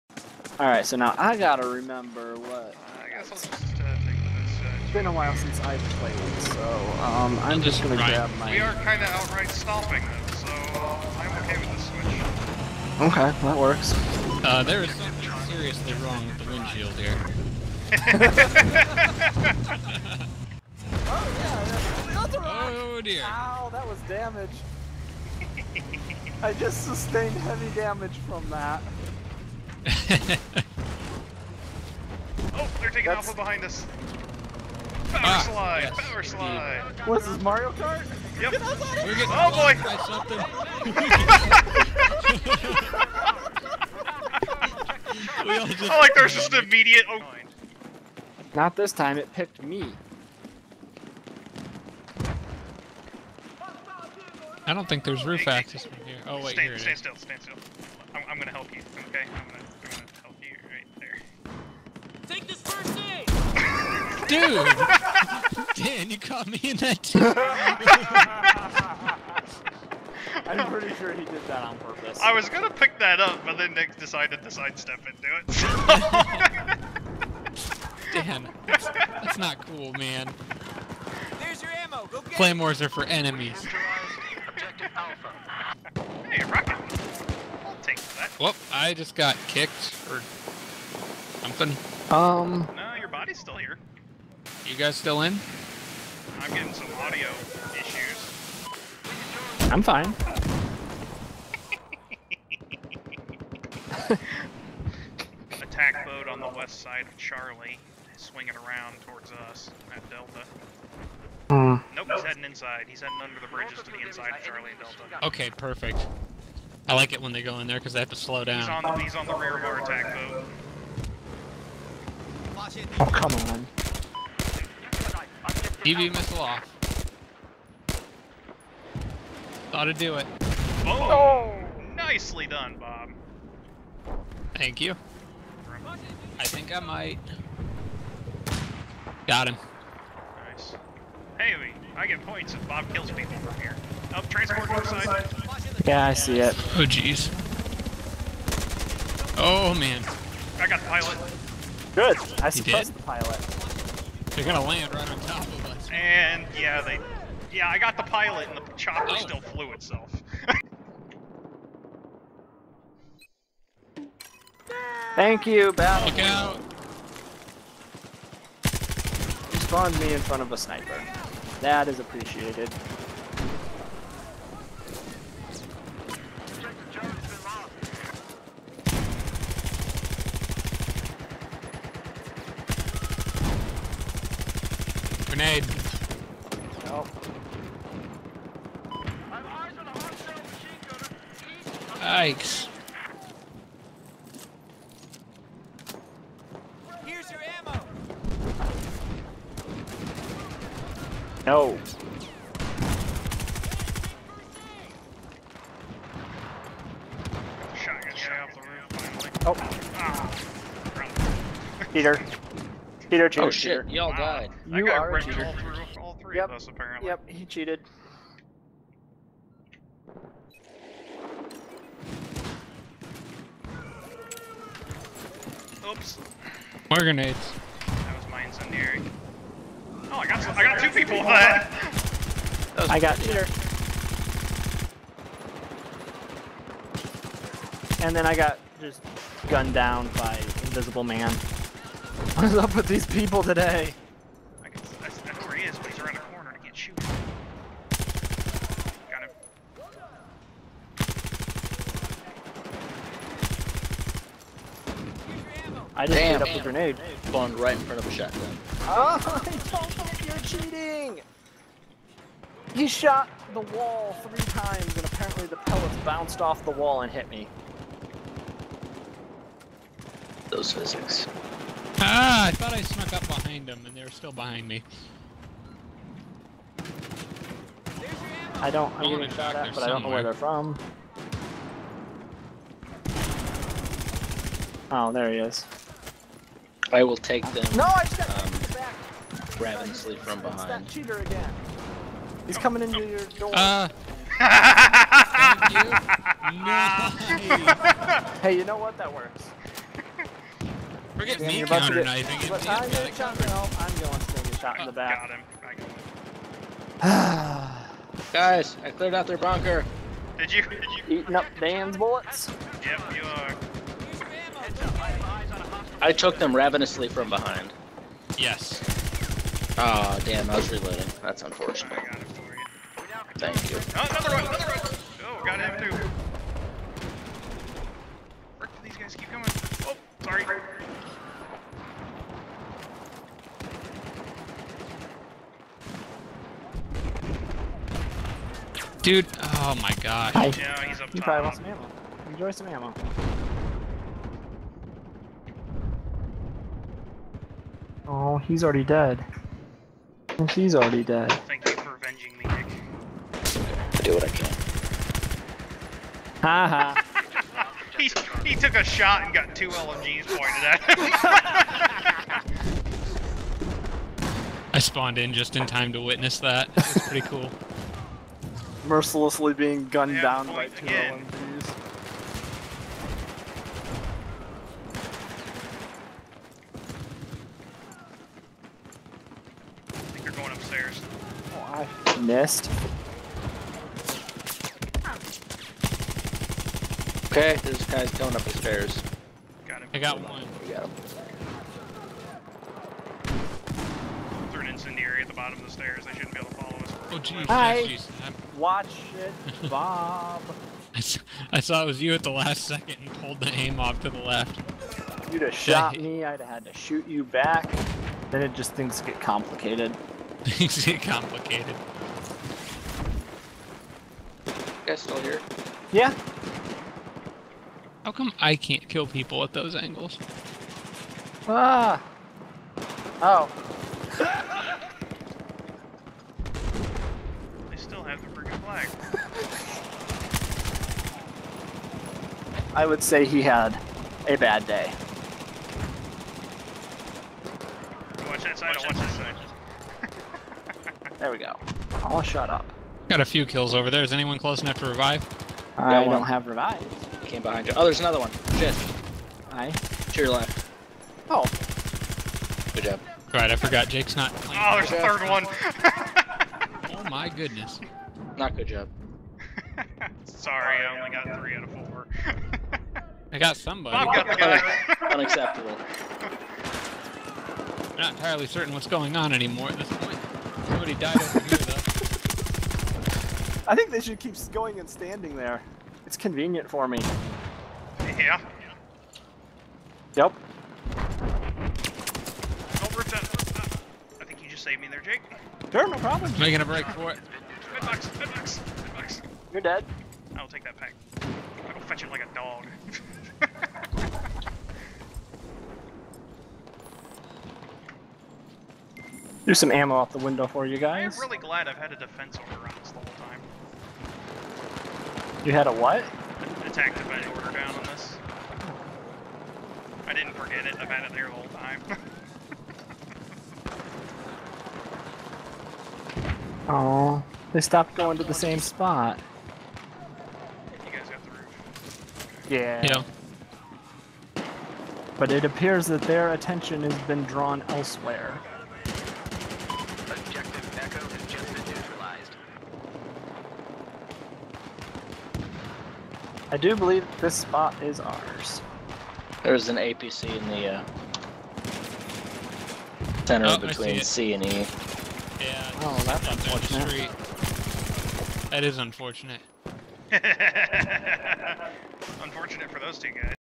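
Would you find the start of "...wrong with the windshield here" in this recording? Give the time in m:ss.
0:15.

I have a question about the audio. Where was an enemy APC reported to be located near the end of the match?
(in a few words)
between C and E.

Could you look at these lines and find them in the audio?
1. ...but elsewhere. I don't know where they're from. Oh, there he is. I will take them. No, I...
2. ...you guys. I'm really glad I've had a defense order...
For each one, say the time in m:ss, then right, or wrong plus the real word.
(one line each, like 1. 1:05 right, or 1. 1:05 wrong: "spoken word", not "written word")
1. 4:39 wrong: "somewhere", not "elsewhere"
2. 8:20 right.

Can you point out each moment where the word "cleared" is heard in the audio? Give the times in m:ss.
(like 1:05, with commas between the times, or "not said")
5:08.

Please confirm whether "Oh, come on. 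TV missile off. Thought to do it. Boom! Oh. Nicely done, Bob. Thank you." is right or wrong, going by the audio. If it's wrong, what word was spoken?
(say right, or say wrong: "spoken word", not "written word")
right.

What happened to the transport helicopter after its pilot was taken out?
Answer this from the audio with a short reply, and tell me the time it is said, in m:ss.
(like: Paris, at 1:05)
flew itself, at 2:39.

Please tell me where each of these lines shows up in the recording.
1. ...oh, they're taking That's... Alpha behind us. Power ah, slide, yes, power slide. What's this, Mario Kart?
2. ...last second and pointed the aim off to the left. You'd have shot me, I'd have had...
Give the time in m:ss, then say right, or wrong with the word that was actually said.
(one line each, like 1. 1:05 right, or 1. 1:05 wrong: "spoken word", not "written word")
1. 0:29 right
2. 6:42 wrong: "pulled", not "pointed".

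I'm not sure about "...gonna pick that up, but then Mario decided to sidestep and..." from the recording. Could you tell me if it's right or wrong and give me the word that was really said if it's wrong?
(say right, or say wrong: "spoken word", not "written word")
wrong: "Nick", not "Mario".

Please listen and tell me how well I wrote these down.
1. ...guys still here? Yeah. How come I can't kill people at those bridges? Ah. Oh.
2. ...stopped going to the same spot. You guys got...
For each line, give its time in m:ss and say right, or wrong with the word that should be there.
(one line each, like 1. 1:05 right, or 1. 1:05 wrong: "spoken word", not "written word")
1. 6:54 wrong: "angles", not "bridges"
2. 8:37 right.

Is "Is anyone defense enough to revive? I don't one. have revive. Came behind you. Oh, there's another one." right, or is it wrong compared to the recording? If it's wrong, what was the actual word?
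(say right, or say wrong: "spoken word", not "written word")
wrong: "close", not "defense".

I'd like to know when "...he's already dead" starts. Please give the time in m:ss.
5:48.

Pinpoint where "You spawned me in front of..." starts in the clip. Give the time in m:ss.
2:49.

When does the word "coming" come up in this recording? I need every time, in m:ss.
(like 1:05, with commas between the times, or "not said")
4:52, 5:29.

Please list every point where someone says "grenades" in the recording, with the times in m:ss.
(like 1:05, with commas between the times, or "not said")
3:46, 4:16.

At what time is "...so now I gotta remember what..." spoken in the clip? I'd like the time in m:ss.
0:00.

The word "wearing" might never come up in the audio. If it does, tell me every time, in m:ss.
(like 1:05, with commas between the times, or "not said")
not said.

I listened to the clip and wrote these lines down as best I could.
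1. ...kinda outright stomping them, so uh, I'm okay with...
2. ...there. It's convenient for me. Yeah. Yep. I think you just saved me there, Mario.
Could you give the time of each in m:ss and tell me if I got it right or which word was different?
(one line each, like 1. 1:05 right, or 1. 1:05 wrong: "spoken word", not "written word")
1. 0:08 right
2. 7:55 wrong: "Jake", not "Mario".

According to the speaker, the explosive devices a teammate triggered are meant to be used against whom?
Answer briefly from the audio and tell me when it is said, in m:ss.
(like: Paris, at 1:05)
enemies, at 1:23.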